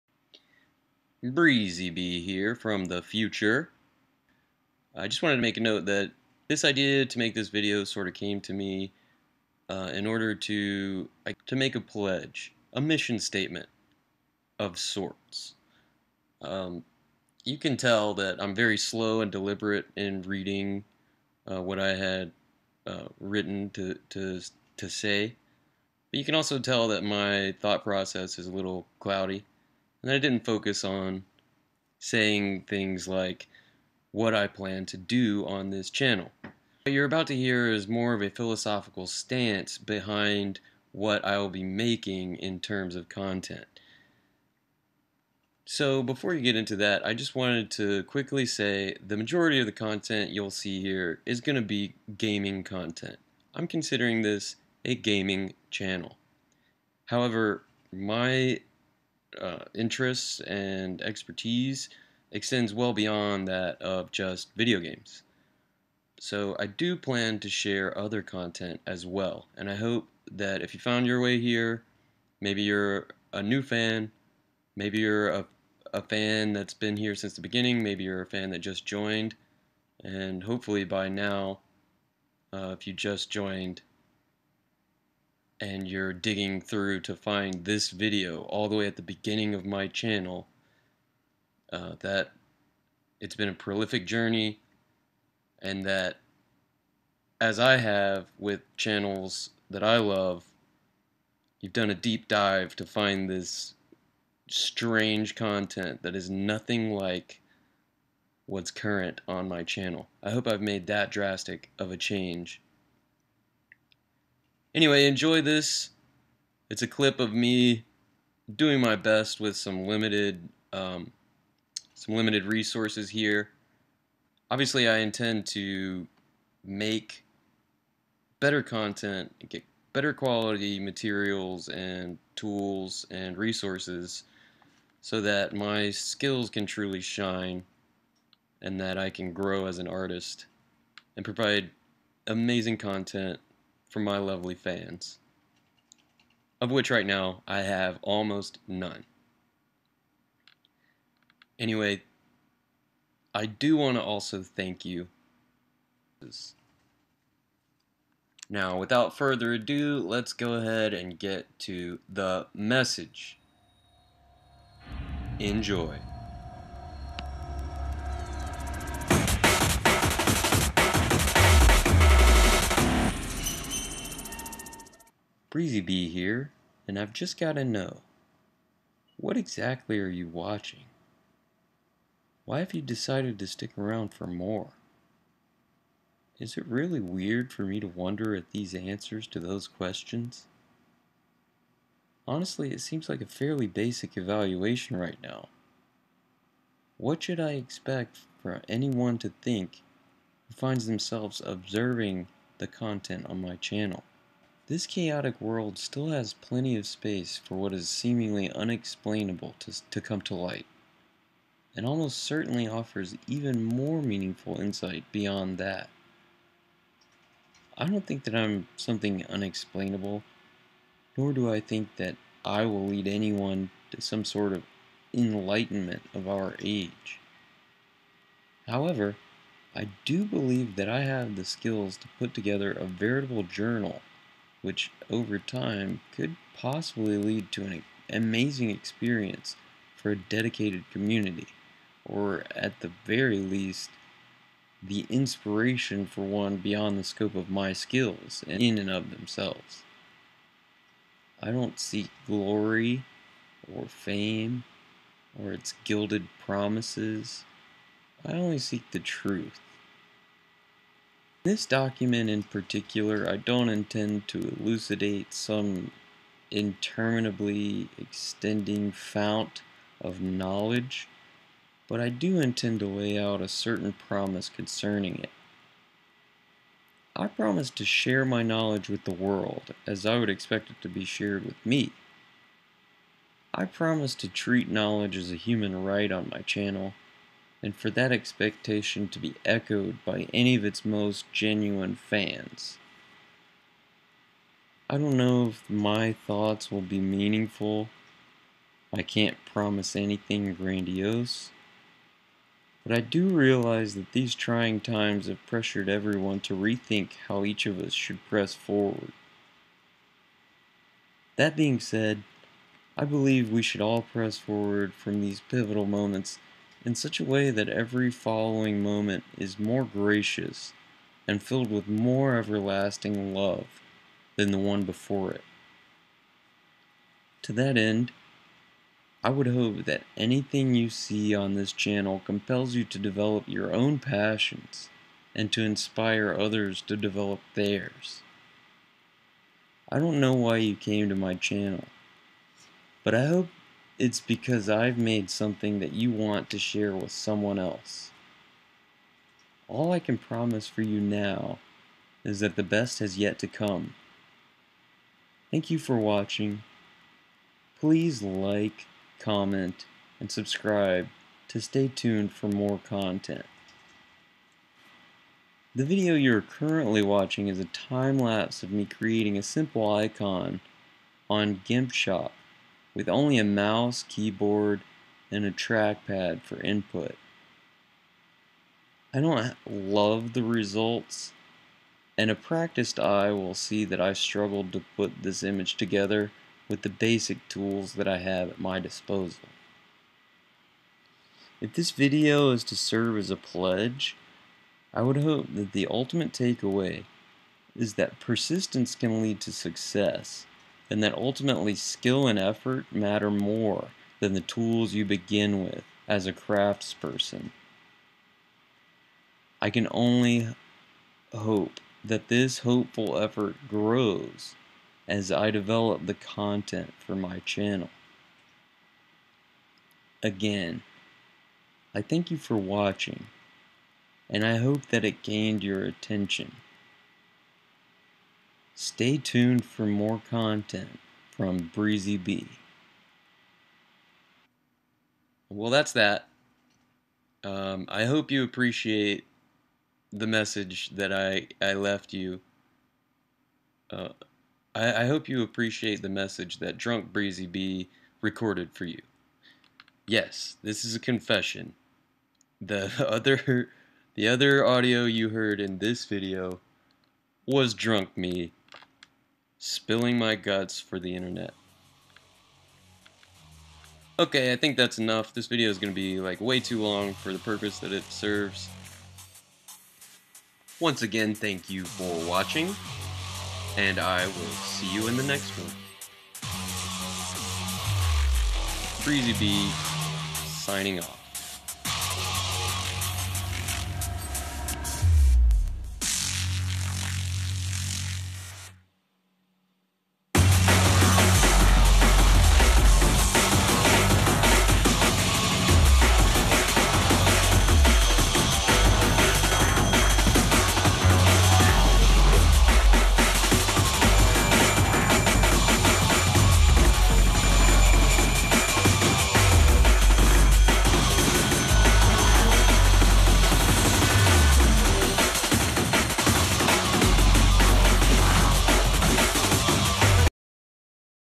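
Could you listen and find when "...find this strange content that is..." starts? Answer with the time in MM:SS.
01:42.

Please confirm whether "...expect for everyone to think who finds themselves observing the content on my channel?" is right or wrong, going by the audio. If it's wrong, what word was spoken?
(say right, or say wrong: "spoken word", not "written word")
wrong: "anyone", not "everyone".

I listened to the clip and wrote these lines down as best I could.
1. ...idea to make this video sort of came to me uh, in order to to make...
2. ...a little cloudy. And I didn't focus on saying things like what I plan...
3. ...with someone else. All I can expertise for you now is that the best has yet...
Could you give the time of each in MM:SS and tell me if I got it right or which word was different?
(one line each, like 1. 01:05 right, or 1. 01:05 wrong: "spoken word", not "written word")
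1. 00:06 right
2. 00:28 right
3. 05:46 wrong: "promise", not "expertise".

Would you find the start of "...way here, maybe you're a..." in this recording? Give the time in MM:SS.
01:11.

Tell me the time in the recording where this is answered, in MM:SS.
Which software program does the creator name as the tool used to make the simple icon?
06:11.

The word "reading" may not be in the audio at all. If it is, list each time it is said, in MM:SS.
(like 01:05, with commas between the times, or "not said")
00:20.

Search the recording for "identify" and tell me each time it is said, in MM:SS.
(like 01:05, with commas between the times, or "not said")
not said.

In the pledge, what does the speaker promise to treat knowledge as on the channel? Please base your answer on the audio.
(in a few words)
a human right.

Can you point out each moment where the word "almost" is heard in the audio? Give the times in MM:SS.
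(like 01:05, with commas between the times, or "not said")
02:28, 03:31.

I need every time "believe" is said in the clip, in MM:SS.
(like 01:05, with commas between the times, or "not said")
03:50, 05:13.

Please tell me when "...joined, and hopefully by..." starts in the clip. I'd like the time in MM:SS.
01:18.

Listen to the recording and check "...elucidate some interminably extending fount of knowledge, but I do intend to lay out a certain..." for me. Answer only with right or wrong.
right.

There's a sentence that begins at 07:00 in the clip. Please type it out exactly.
Again, I thank you for watching, and I hope that it gained your attention.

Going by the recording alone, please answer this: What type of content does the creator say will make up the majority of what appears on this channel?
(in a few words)
gaming content.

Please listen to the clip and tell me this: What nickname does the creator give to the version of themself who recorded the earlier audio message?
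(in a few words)
Drunk Breezy B.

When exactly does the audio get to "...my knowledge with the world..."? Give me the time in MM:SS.
04:38.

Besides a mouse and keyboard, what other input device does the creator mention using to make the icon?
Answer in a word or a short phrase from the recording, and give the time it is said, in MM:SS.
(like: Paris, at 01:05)
a trackpad, at 06:15.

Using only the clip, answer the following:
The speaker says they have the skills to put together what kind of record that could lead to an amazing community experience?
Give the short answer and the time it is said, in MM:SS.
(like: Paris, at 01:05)
a veritable journal, at 03:52.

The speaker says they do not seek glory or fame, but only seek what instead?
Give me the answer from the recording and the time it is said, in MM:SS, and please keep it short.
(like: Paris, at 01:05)
the truth, at 04:18.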